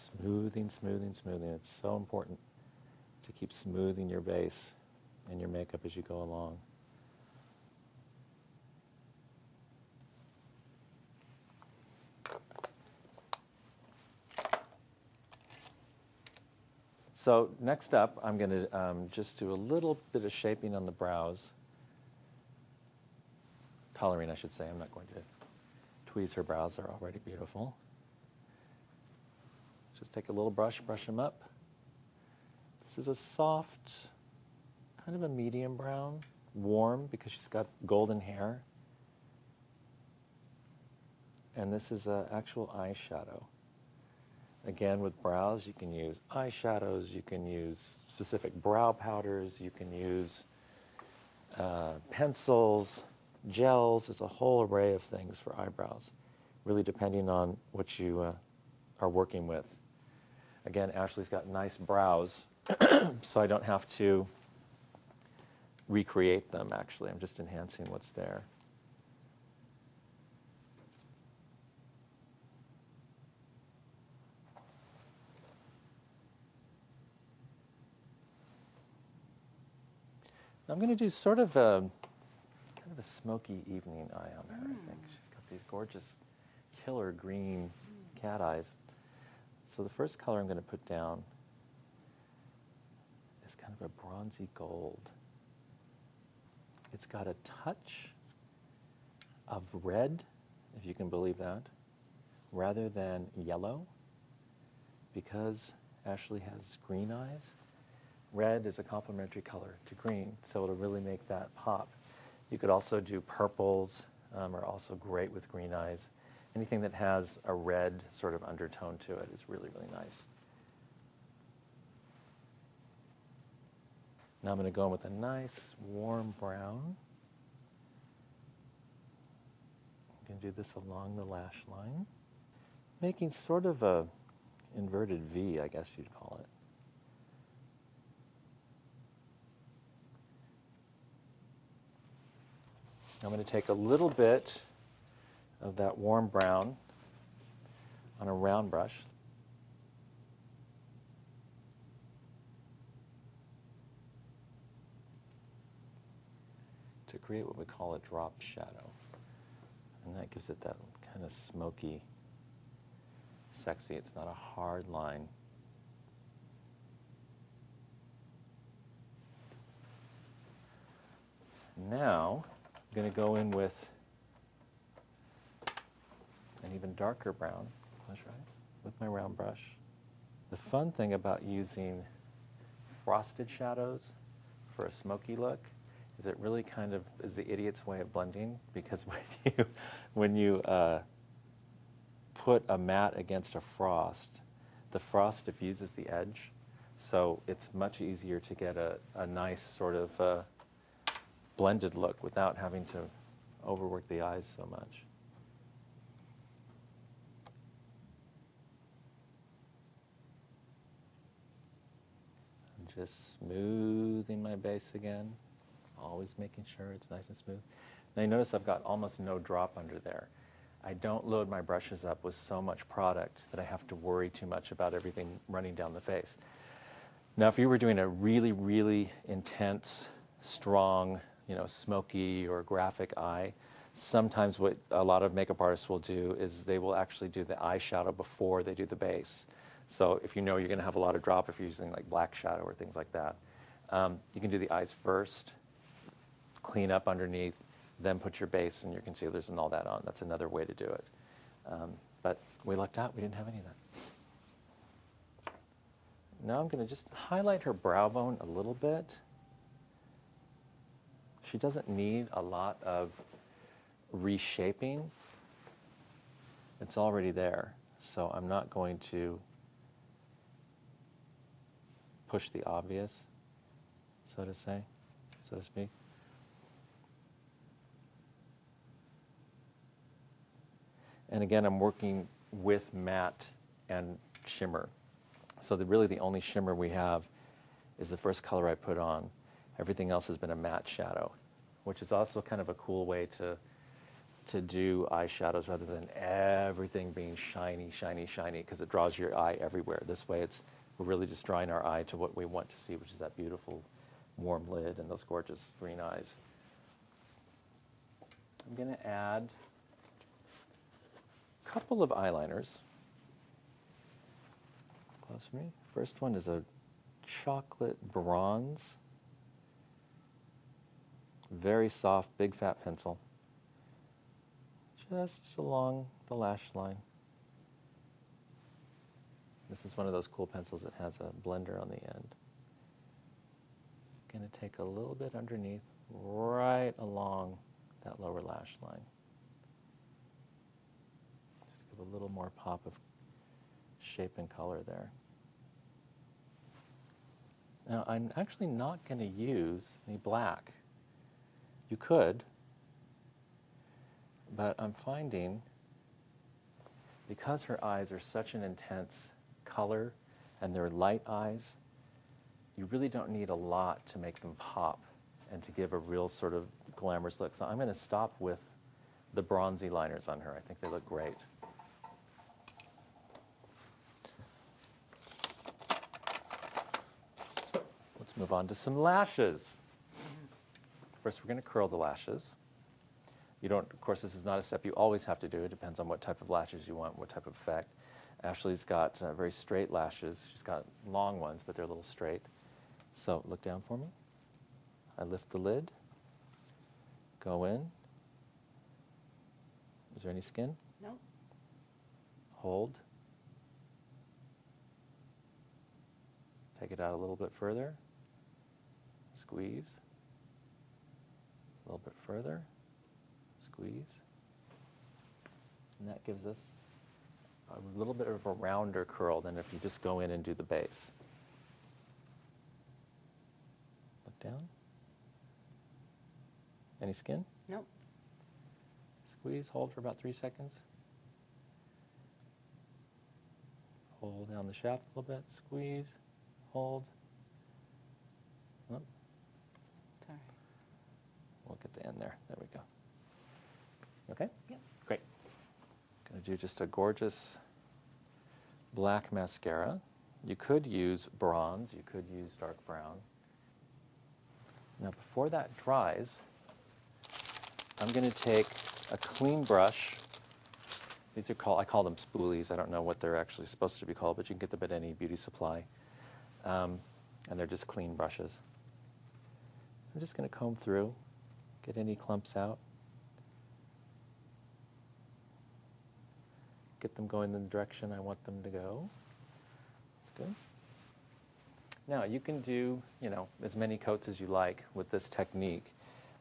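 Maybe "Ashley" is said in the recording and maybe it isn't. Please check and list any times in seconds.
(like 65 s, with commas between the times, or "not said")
60 s, 106 s, 388 s.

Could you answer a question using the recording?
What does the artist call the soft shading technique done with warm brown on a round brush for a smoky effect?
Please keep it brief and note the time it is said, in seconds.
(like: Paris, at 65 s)
Drop shadow, at 157 s.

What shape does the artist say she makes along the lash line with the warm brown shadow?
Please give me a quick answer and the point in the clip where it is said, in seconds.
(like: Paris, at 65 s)
Inverted V, at 134 s.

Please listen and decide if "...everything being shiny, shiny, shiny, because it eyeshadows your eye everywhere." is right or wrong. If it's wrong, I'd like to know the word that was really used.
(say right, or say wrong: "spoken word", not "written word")
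wrong: "draws", not "eyeshadows".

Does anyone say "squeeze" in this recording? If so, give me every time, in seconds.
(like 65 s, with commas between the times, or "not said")
409 s, 413 s, 429 s, 435 s.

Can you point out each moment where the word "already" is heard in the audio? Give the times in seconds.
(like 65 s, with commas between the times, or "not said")
26 s, 266 s.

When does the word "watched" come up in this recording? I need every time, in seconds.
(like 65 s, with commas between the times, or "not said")
not said.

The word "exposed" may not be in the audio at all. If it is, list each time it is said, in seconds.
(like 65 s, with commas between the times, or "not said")
not said.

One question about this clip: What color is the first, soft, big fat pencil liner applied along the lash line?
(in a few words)
Chocolate bronze.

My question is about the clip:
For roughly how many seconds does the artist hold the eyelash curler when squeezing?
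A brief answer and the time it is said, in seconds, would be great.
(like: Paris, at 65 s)
3, at 430 s.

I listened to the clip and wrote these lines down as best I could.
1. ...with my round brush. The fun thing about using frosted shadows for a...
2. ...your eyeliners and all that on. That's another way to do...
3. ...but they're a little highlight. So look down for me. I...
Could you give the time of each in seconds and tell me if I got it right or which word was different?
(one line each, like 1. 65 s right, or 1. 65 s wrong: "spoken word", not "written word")
1. 178 s right
2. 248 s wrong: "concealers", not "eyeliners"
3. 391 s wrong: "straight", not "highlight".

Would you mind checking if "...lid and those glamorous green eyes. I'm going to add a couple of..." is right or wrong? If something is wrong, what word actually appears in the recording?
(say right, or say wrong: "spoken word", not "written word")
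wrong: "gorgeous", not "glamorous".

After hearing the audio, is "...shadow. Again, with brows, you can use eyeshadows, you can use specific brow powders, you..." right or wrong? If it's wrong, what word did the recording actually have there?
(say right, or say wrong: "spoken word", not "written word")
wrong: "eyeshadow", not "shadow".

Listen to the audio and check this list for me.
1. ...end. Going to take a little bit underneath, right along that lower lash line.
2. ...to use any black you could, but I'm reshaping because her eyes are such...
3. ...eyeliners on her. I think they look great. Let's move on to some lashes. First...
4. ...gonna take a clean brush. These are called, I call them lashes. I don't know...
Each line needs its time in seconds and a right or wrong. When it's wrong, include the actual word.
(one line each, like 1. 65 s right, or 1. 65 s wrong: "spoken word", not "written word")
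1. 332 s right
2. 349 s wrong: "finding", not "reshaping"
3. 369 s wrong: "liners", not "eyeliners"
4. 458 s wrong: "spoolies", not "lashes".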